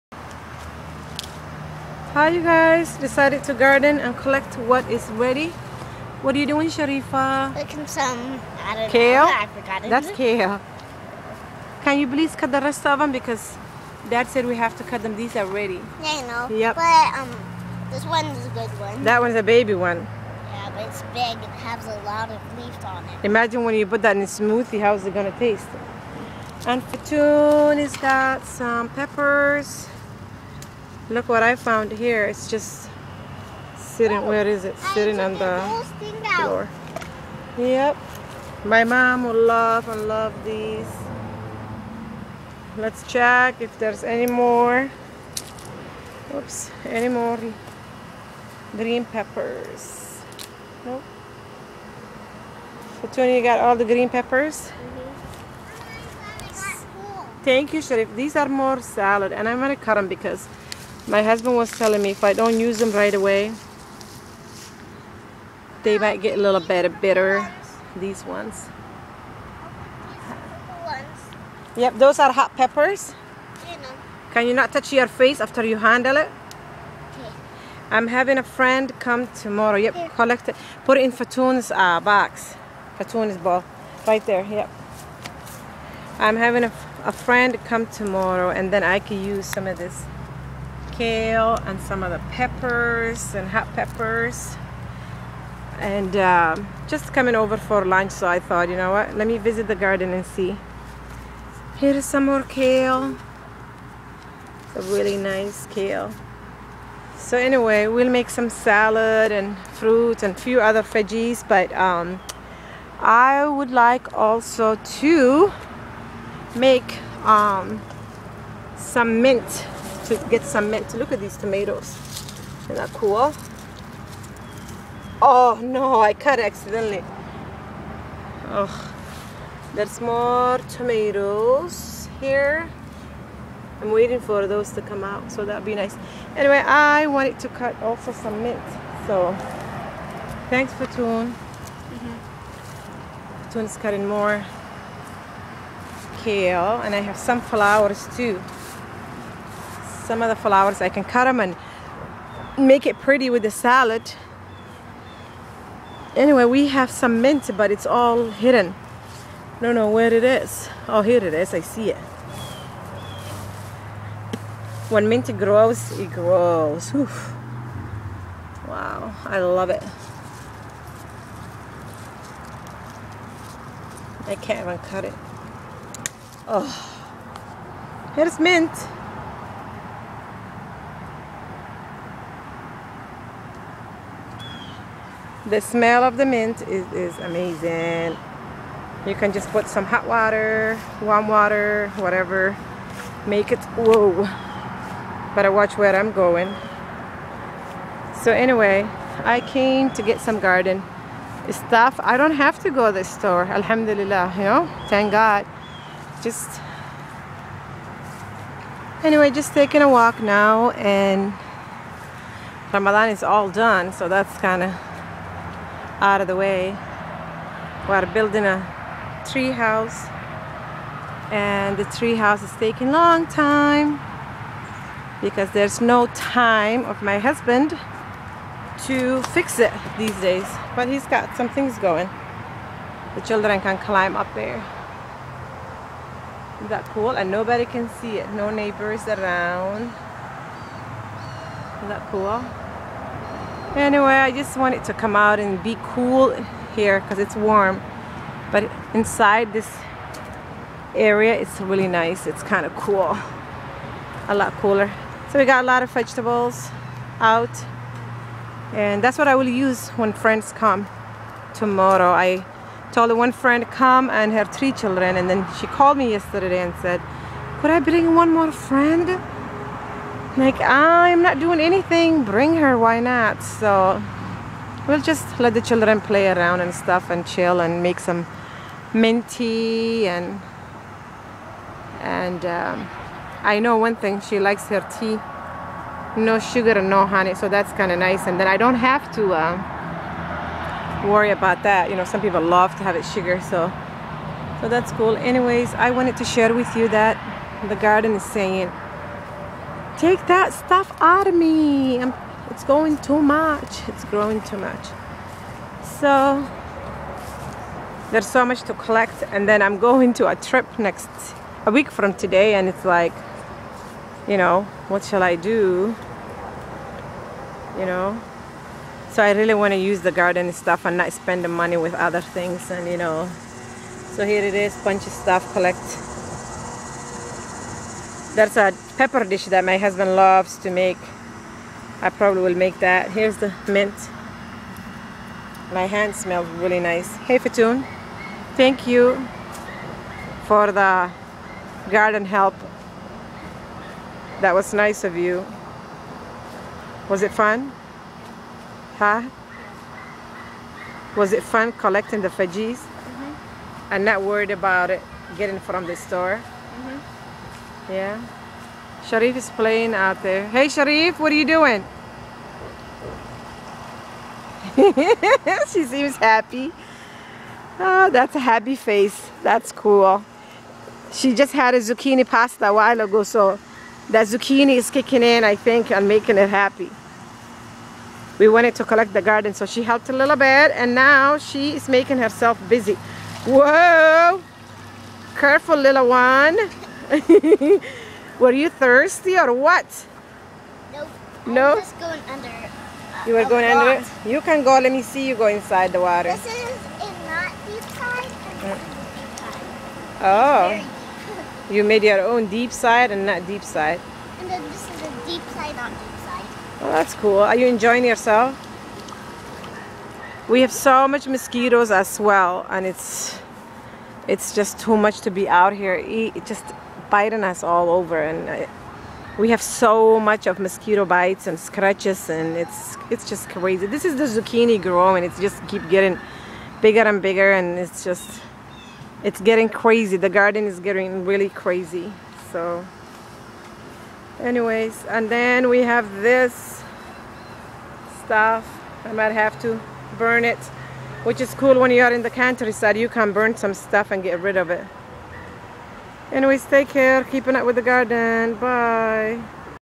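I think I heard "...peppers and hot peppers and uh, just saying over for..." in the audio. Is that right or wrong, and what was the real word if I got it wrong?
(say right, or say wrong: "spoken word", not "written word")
wrong: "coming", not "saying".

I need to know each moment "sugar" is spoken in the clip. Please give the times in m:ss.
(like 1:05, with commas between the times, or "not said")
4:46, 4:53.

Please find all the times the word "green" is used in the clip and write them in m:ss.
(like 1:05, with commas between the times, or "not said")
0:48, 0:53.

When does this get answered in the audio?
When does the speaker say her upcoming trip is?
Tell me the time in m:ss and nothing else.
5:11.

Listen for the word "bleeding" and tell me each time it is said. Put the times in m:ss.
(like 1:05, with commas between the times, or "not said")
not said.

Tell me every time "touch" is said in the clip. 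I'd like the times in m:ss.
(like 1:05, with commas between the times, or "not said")
1:14.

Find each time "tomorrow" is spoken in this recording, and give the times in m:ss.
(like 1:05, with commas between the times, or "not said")
1:19, 1:27, 4:21.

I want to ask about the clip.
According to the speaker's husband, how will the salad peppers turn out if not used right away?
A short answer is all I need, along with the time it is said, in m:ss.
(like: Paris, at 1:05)
a little bit bitter, at 1:06.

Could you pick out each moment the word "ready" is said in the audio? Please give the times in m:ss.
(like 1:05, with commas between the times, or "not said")
0:05, 0:15.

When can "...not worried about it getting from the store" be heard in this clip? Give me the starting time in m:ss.
5:54.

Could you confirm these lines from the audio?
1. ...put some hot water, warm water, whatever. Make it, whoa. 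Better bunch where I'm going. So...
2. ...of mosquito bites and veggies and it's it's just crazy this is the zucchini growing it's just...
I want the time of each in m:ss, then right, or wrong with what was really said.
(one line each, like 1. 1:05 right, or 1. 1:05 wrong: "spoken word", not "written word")
1. 3:09 wrong: "watch", not "bunch"
2. 7:00 wrong: "scratches", not "veggies".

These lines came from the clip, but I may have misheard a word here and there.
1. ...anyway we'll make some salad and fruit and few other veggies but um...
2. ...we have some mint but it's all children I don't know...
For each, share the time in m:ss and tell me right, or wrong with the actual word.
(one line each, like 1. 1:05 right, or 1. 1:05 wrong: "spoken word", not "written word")
1. 1:47 right
2. 2:36 wrong: "hidden", not "children".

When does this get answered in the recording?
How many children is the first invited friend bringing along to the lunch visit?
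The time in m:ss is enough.
4:24.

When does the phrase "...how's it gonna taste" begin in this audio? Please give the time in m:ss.
0:24.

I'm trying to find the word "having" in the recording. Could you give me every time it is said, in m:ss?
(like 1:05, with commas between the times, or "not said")
1:18, 1:26.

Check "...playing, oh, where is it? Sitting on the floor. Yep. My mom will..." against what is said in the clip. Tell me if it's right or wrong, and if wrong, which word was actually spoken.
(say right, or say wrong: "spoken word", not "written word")
wrong: "sitting", not "playing".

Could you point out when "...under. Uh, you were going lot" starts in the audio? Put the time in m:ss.
6:32.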